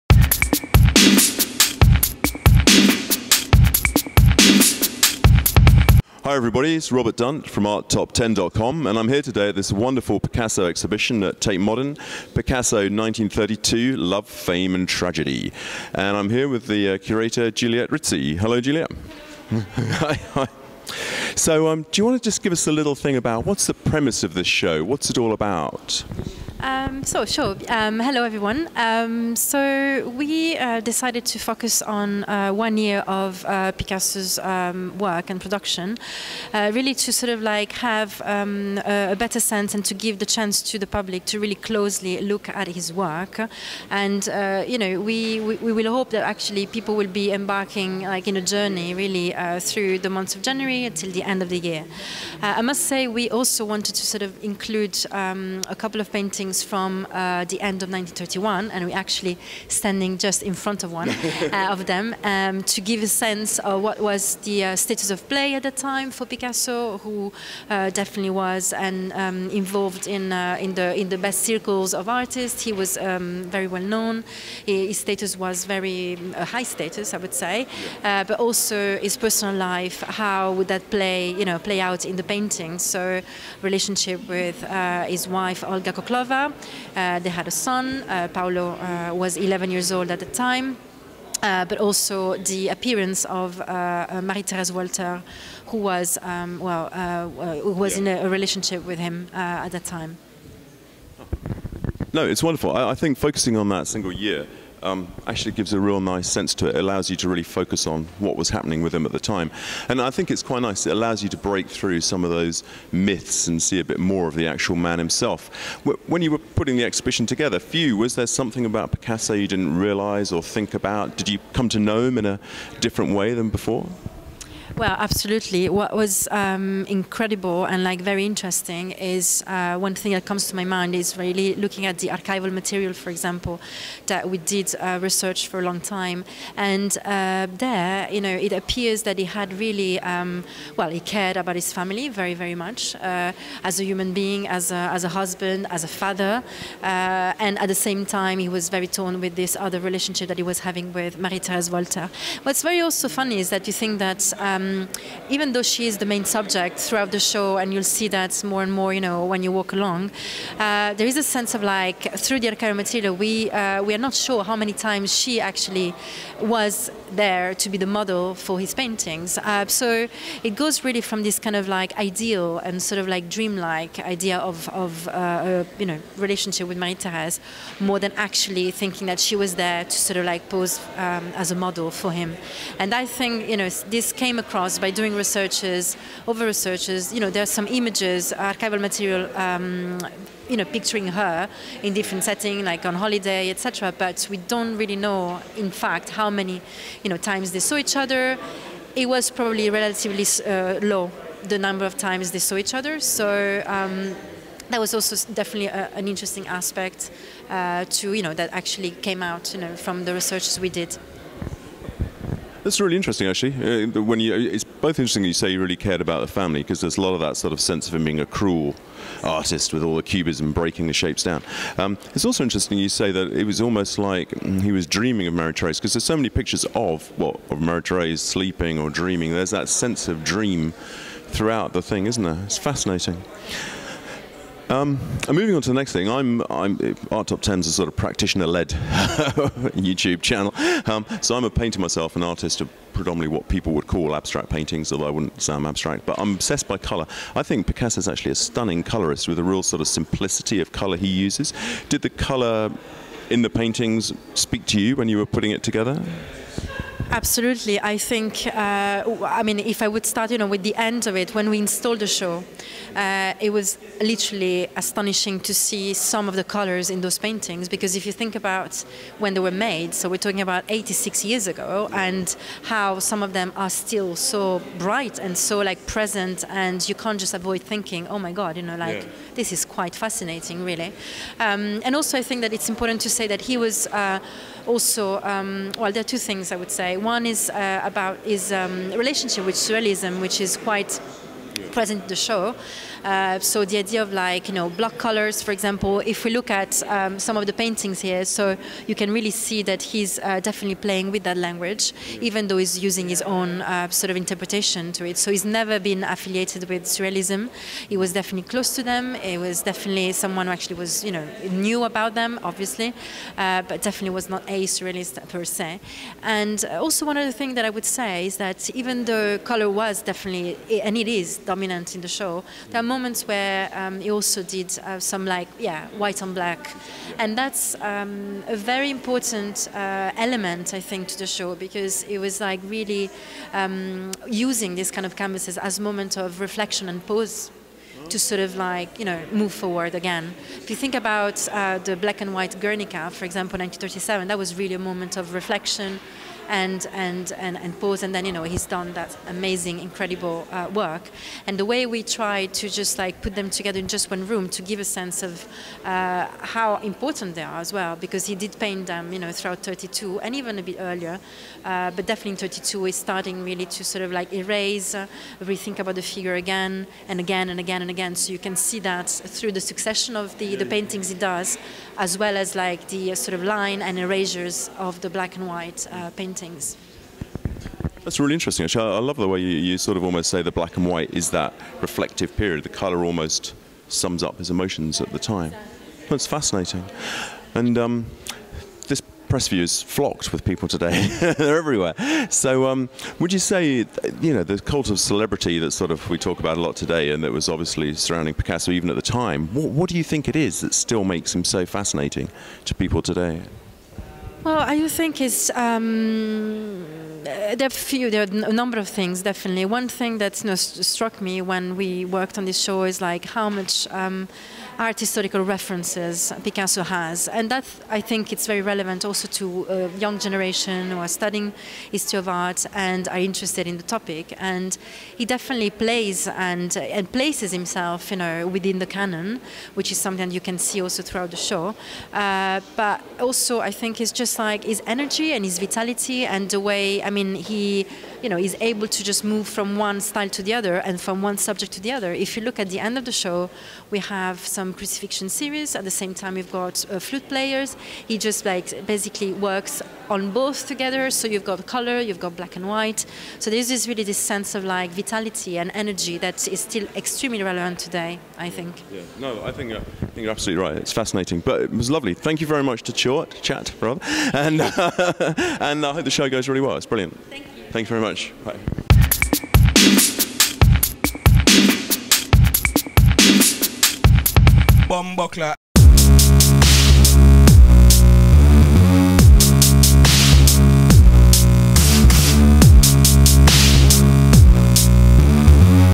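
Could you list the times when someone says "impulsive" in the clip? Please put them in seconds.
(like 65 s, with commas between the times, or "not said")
not said.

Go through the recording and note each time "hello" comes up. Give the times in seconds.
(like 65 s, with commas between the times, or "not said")
18 s, 27 s.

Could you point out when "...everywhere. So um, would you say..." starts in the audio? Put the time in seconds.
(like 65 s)
391 s.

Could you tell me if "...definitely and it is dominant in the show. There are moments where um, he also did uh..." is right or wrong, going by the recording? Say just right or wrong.
right.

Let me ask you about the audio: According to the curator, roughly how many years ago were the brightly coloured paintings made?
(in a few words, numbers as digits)
86.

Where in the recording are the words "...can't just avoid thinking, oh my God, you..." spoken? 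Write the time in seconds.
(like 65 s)
276 s.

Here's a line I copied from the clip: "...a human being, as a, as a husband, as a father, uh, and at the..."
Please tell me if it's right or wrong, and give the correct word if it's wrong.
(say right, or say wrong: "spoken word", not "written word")
right.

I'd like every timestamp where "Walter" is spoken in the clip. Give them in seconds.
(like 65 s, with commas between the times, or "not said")
94 s, 151 s.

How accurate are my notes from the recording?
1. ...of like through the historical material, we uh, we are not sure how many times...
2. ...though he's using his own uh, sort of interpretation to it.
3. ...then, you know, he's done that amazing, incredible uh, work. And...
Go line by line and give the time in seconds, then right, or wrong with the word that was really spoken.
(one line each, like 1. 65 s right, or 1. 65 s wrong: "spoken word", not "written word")
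1. 161 s wrong: "archival", not "historical"
2. 302 s right
3. 348 s right.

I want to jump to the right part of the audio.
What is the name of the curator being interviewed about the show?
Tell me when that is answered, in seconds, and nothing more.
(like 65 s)
17 s.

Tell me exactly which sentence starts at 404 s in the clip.
Well, I think it's um, uh, there are few, there are a number of things definitely.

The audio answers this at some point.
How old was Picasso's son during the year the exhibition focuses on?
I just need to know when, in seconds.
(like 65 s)
89 s.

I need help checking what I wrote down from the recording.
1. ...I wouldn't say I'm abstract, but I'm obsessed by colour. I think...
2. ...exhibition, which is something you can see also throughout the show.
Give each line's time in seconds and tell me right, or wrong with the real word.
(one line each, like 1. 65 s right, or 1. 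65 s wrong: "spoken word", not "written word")
1. 245 s right
2. 428 s wrong: "canon", not "exhibition".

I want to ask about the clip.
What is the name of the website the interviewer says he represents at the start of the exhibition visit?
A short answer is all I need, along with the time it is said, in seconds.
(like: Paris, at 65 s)
ArtTop10.com, at 7 s.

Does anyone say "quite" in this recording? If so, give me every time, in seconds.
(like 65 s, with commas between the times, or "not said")
110 s, 279 s, 290 s.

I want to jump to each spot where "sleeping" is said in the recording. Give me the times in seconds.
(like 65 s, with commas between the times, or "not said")
228 s.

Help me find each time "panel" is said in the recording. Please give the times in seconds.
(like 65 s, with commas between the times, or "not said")
not said.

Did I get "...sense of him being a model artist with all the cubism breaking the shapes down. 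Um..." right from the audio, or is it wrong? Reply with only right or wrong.
wrong.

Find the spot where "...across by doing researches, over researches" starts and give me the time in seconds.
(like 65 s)
184 s.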